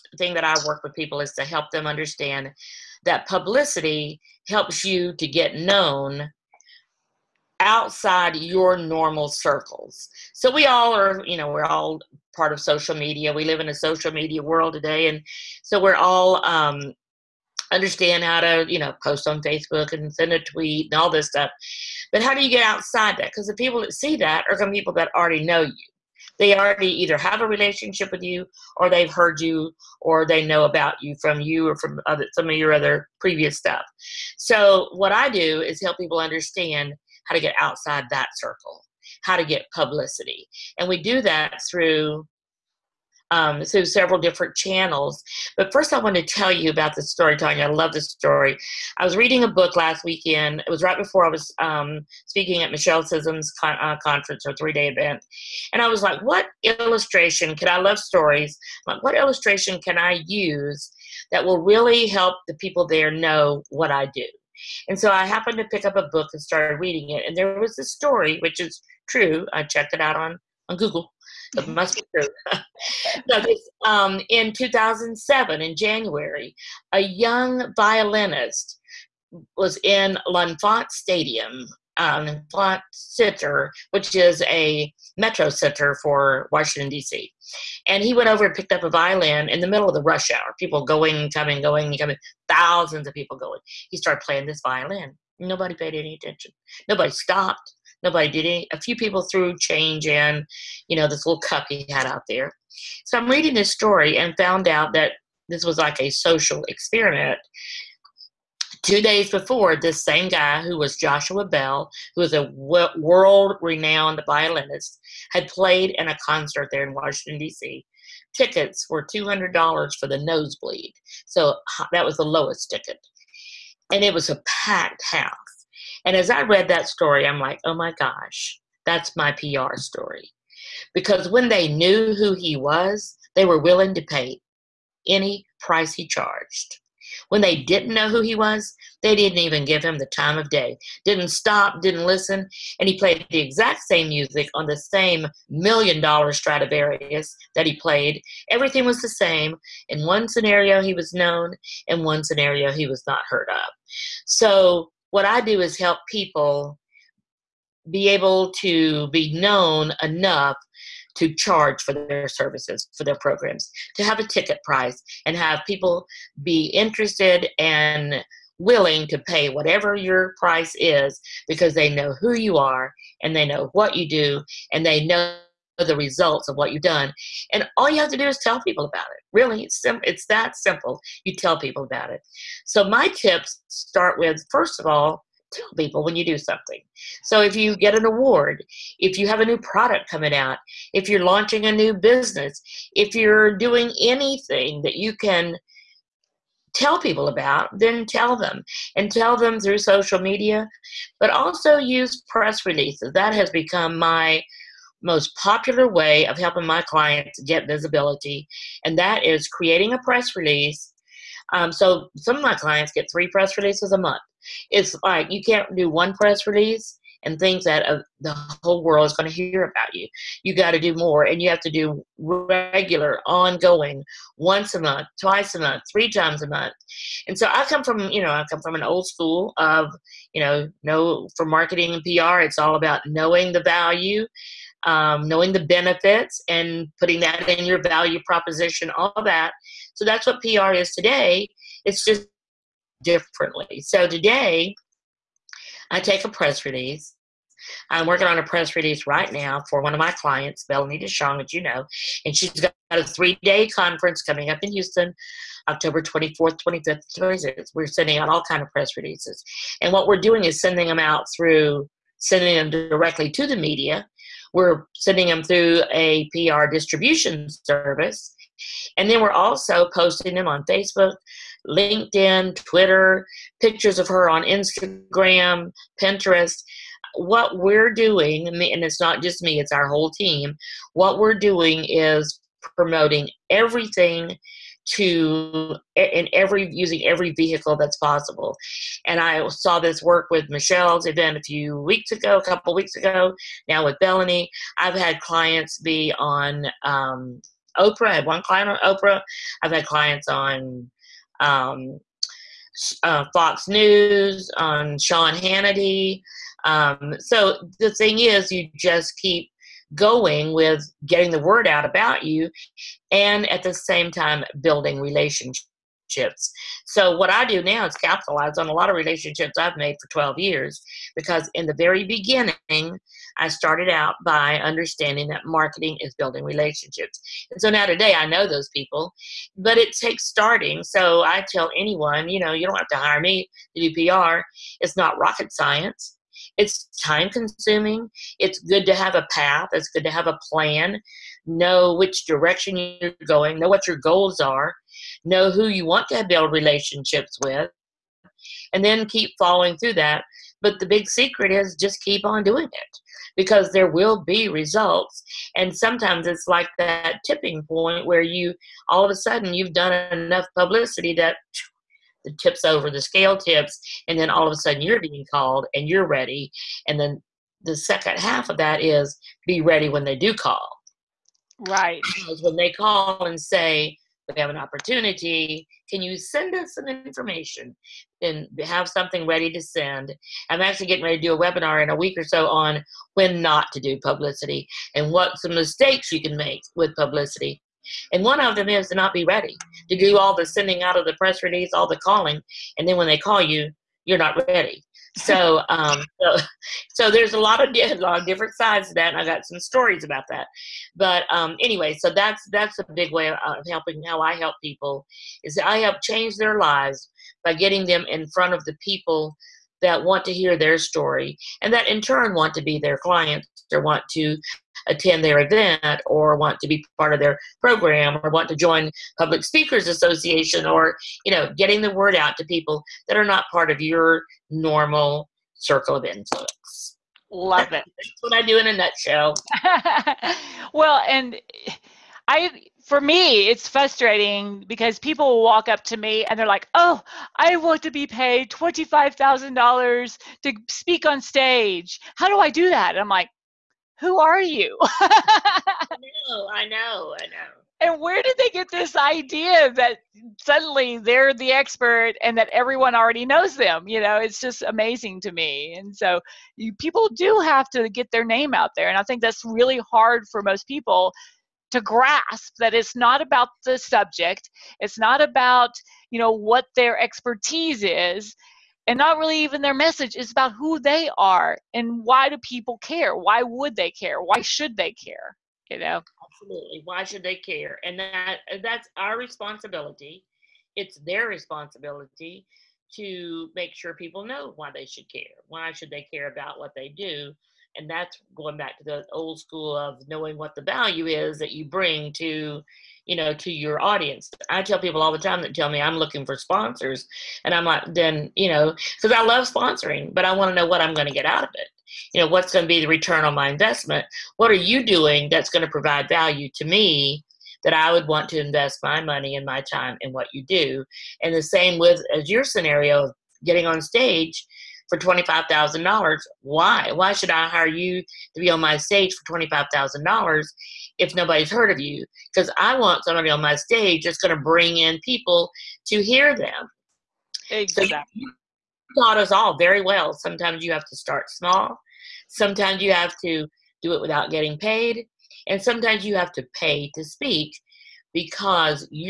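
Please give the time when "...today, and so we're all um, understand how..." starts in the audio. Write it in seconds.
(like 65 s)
14 s.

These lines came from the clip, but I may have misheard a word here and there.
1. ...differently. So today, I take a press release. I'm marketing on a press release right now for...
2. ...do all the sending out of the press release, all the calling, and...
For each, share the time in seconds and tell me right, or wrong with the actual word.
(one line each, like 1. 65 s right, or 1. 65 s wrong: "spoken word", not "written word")
1. 243 s wrong: "working", not "marketing"
2. 389 s right.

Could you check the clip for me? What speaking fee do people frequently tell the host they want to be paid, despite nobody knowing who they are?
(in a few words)
$25,000.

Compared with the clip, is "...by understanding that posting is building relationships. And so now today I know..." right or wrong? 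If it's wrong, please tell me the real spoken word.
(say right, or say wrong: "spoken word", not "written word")
wrong: "marketing", not "posting".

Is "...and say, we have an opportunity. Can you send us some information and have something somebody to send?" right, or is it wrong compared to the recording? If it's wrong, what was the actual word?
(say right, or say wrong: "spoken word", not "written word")
wrong: "ready", not "somebody".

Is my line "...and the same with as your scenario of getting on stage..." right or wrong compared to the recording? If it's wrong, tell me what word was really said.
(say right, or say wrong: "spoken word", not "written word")
right.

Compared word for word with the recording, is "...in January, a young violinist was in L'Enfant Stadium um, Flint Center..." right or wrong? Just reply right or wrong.
right.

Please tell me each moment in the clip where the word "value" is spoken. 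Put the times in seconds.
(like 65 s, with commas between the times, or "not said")
233 s, 237 s, 490 s, 506 s.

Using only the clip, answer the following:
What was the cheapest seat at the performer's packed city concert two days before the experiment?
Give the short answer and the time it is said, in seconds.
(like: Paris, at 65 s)
$200, at 119 s.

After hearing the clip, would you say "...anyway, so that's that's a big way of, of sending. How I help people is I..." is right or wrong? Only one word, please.
wrong.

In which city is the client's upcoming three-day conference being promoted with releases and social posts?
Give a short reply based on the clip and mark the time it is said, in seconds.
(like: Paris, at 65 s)
Houston, at 254 s.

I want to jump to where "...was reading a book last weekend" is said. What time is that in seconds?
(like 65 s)
49 s.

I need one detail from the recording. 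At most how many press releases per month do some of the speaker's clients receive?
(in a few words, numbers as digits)
3.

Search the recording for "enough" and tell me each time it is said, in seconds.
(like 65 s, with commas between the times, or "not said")
160 s, 360 s.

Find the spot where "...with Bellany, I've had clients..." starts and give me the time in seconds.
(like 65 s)
293 s.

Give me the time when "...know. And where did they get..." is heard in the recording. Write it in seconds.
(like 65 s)
447 s.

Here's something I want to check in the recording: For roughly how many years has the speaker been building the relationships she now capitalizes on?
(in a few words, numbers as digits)
12.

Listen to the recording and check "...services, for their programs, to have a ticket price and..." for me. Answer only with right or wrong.
right.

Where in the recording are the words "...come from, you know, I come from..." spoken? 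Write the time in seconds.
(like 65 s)
227 s.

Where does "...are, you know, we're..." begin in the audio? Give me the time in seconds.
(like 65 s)
10 s.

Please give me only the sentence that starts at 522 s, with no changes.
Because I want somebody on my stage that's going to bring in people to hear them.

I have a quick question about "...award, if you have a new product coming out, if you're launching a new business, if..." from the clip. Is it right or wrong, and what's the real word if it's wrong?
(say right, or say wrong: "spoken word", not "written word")
right.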